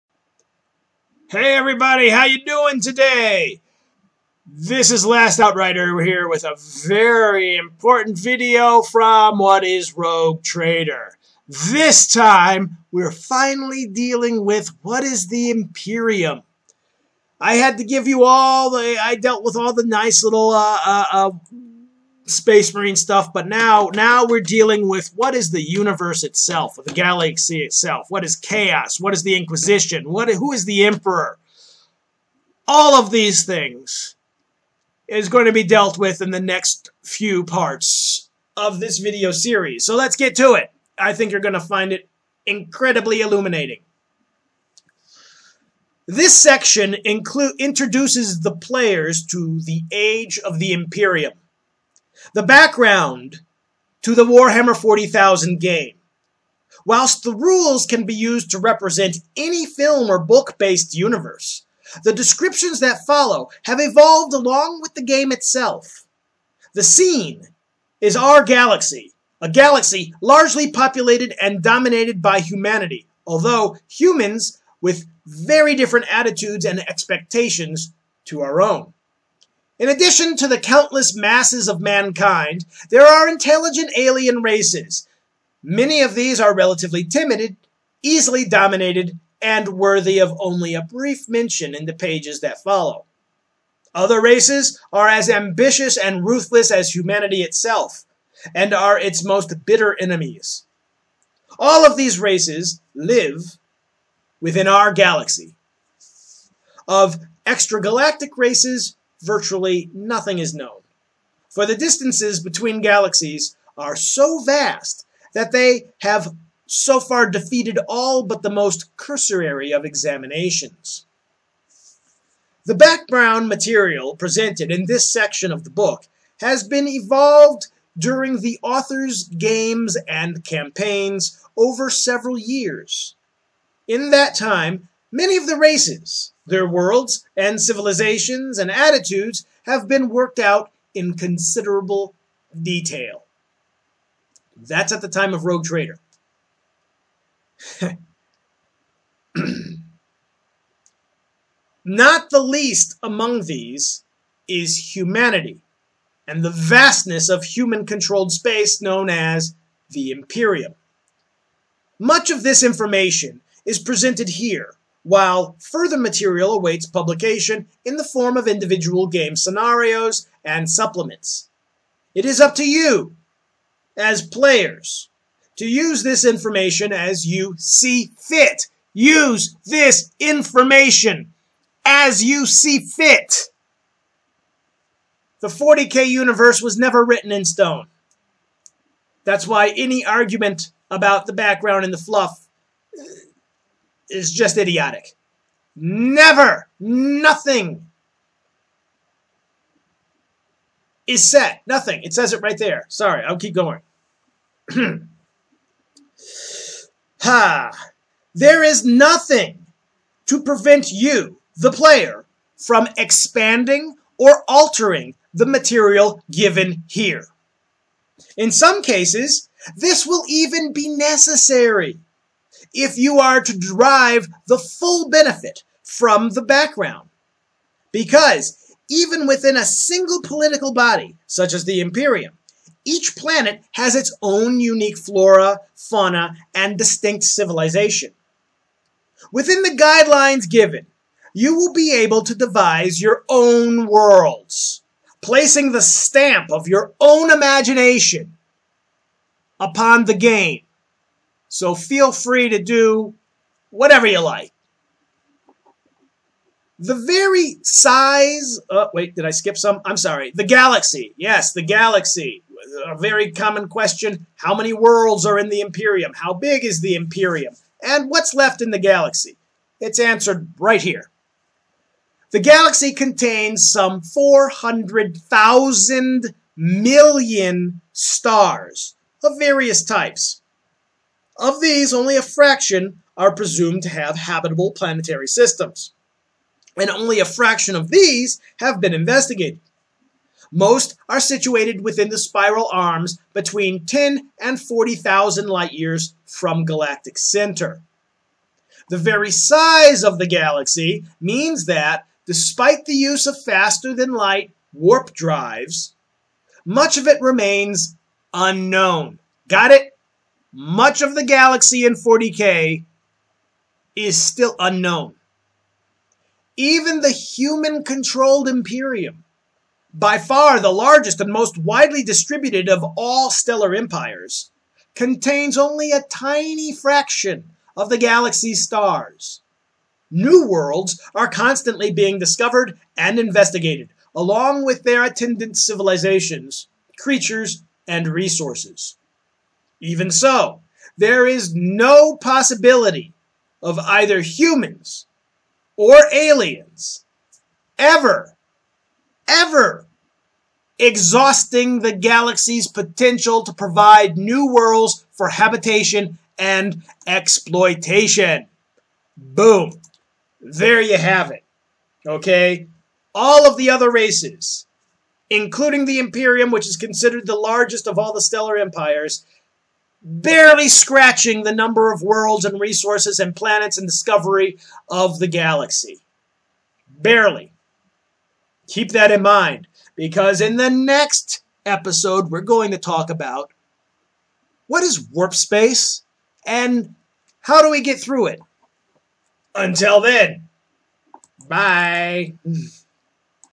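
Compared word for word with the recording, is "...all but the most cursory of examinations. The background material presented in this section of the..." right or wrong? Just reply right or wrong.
right.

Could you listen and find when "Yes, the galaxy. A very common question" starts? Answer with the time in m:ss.
4:21.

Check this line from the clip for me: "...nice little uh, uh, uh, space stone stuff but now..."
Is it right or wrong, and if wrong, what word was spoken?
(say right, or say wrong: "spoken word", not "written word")
wrong: "marine", not "stone".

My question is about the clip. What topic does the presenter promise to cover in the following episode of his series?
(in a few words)
warp space.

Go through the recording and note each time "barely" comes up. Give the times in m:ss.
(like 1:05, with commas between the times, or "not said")
6:10, 6:16.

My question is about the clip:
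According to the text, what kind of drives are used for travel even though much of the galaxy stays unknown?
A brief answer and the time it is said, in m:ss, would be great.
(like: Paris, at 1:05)
faster than light warp drives, at 5:03.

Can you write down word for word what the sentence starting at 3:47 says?
Because even within a single political body, such as the Imperium, each planet has its own unique flora, fauna, and distinct civilization.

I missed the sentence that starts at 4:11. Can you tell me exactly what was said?
So feel free to do whatever you like.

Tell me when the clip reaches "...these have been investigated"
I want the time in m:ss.
4:47.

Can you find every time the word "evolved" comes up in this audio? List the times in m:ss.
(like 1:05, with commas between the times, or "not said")
1:03, 2:06.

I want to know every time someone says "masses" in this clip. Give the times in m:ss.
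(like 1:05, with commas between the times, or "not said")
1:21.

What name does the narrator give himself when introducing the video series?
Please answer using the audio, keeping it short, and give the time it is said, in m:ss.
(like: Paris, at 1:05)
Last Outrider, at 0:05.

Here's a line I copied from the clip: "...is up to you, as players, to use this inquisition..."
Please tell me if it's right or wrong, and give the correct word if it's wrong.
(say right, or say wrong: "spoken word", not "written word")
wrong: "information", not "inquisition".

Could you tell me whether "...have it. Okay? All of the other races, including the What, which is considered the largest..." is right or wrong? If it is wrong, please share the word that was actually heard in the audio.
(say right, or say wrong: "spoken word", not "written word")
wrong: "Imperium", not "What".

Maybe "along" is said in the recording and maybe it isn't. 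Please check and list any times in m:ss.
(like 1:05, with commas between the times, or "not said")
1:04, 5:34.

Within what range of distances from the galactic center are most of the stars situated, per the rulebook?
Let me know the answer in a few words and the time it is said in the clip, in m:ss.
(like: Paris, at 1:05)
10 to 40,000 light years, at 4:53.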